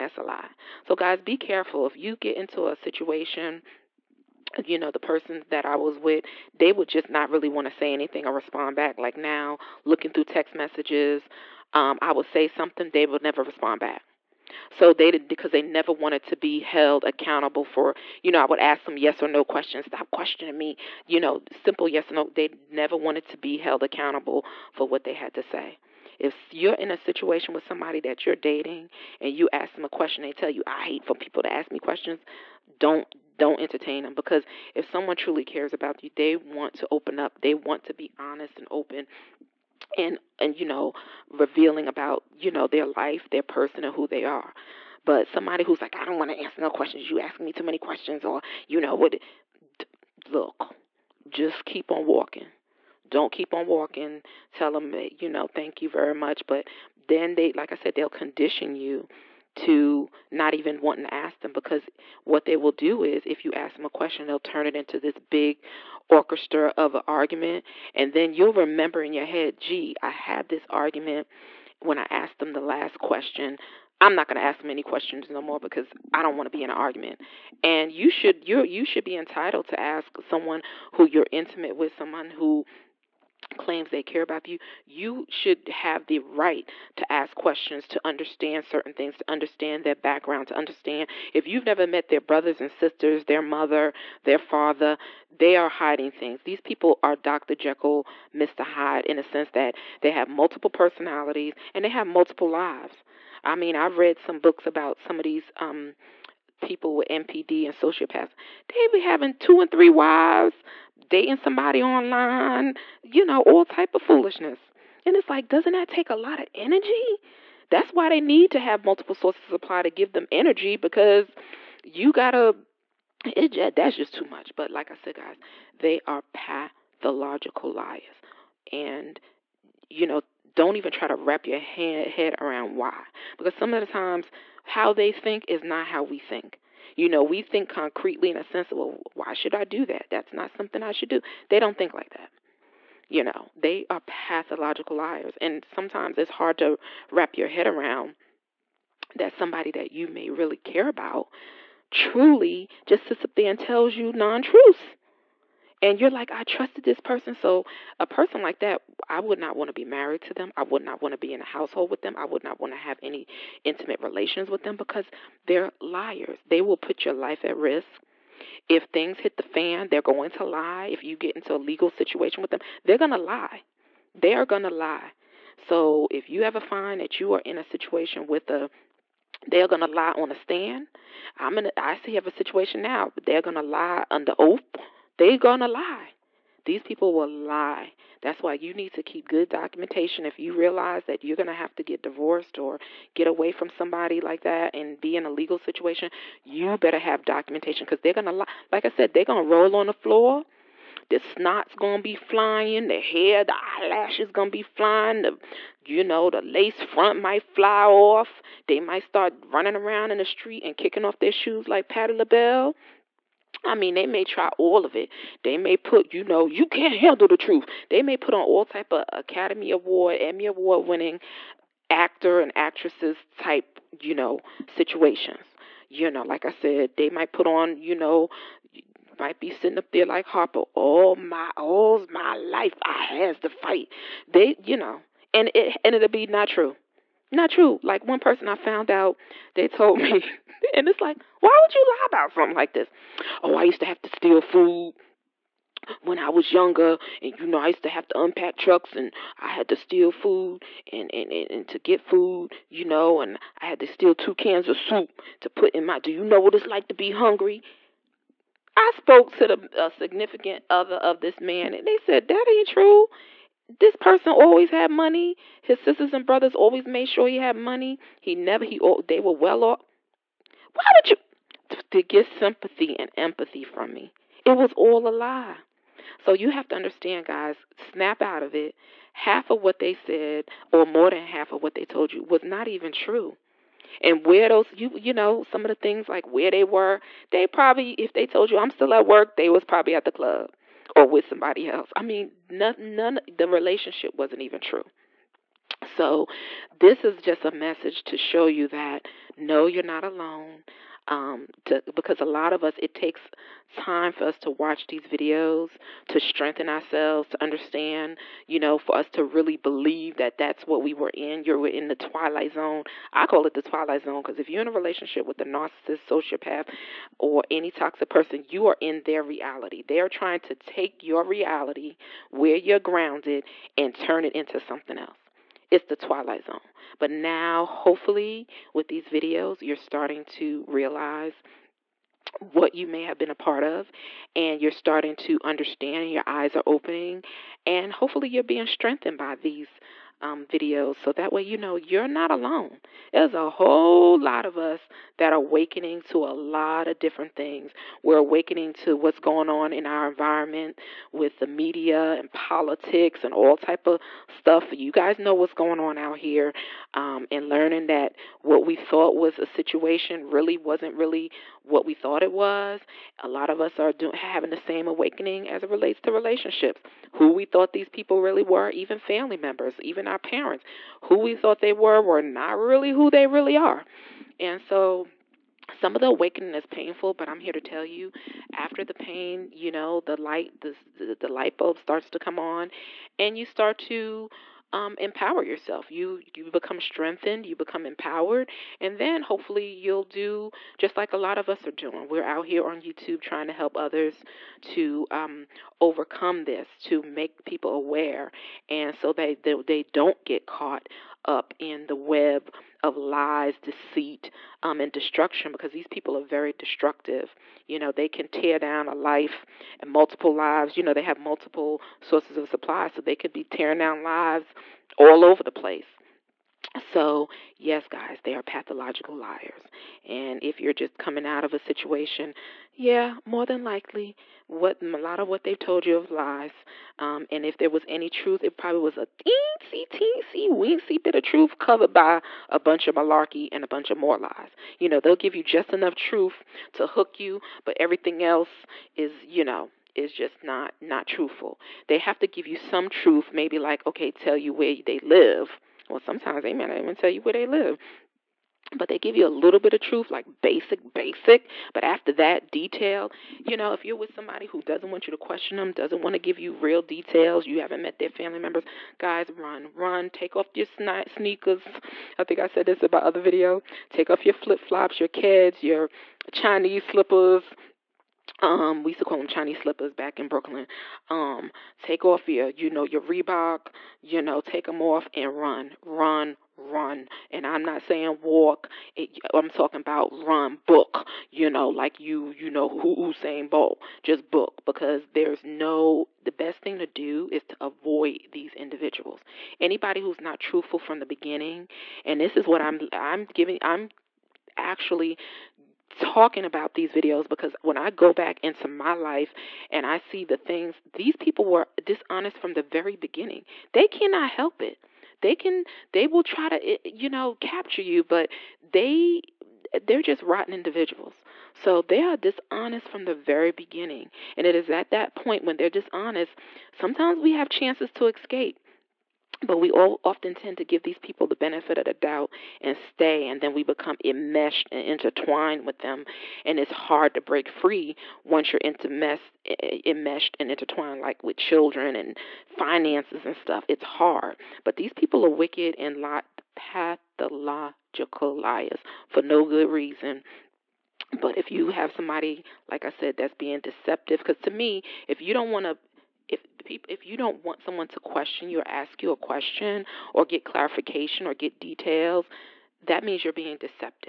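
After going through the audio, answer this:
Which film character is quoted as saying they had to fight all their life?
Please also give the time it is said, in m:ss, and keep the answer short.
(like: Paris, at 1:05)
Harpo, at 3:50.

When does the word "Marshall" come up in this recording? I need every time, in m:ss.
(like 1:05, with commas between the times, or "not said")
not said.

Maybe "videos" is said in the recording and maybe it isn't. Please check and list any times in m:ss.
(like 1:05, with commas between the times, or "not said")
5:05, 5:29, 5:40, 7:43, 8:16.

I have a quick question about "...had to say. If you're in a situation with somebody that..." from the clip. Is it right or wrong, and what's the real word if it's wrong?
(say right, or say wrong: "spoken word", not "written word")
right.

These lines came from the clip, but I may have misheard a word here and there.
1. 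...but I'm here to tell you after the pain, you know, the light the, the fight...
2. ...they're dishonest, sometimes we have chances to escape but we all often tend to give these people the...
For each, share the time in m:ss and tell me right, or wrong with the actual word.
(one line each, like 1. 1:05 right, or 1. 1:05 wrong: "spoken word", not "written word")
1. 6:17 wrong: "light", not "fight"
2. 8:35 right.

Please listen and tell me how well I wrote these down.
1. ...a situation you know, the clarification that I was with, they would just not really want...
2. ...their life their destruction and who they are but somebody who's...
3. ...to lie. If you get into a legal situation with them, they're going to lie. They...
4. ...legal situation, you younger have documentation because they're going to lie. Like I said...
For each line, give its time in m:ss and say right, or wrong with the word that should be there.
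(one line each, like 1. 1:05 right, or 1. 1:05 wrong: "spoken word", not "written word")
1. 0:02 wrong: "person", not "clarification"
2. 0:42 wrong: "person", not "destruction"
3. 2:50 right
4. 3:15 wrong: "better", not "younger".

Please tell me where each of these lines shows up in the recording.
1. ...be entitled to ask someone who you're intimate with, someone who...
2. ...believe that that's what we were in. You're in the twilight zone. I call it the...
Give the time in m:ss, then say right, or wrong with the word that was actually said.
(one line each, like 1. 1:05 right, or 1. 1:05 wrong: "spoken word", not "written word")
1. 1:19 right
2. 5:09 right.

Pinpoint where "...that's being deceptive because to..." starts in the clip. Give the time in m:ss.
9:03.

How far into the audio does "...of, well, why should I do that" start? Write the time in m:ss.
2:18.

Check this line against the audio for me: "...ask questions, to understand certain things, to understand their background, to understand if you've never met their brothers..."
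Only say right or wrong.
right.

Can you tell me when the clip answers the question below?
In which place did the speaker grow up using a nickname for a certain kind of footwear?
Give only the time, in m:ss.
7:50.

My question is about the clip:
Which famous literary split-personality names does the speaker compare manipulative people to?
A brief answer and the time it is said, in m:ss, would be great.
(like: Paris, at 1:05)
Dr. Jekyll, Mr. Hyde, at 1:37.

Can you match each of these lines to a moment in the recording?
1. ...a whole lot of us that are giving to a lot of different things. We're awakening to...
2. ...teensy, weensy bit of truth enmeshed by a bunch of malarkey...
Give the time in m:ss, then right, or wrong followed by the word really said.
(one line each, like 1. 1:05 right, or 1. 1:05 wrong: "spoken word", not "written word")
1. 5:43 wrong: "awakening", not "giving"
2. 7:09 wrong: "covered", not "enmeshed".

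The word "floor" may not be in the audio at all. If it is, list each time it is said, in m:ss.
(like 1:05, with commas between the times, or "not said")
3:19.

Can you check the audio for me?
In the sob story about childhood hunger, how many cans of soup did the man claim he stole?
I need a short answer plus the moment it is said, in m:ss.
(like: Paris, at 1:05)
2, at 4:14.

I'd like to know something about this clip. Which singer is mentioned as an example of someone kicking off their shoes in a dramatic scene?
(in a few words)
Patti LaBelle.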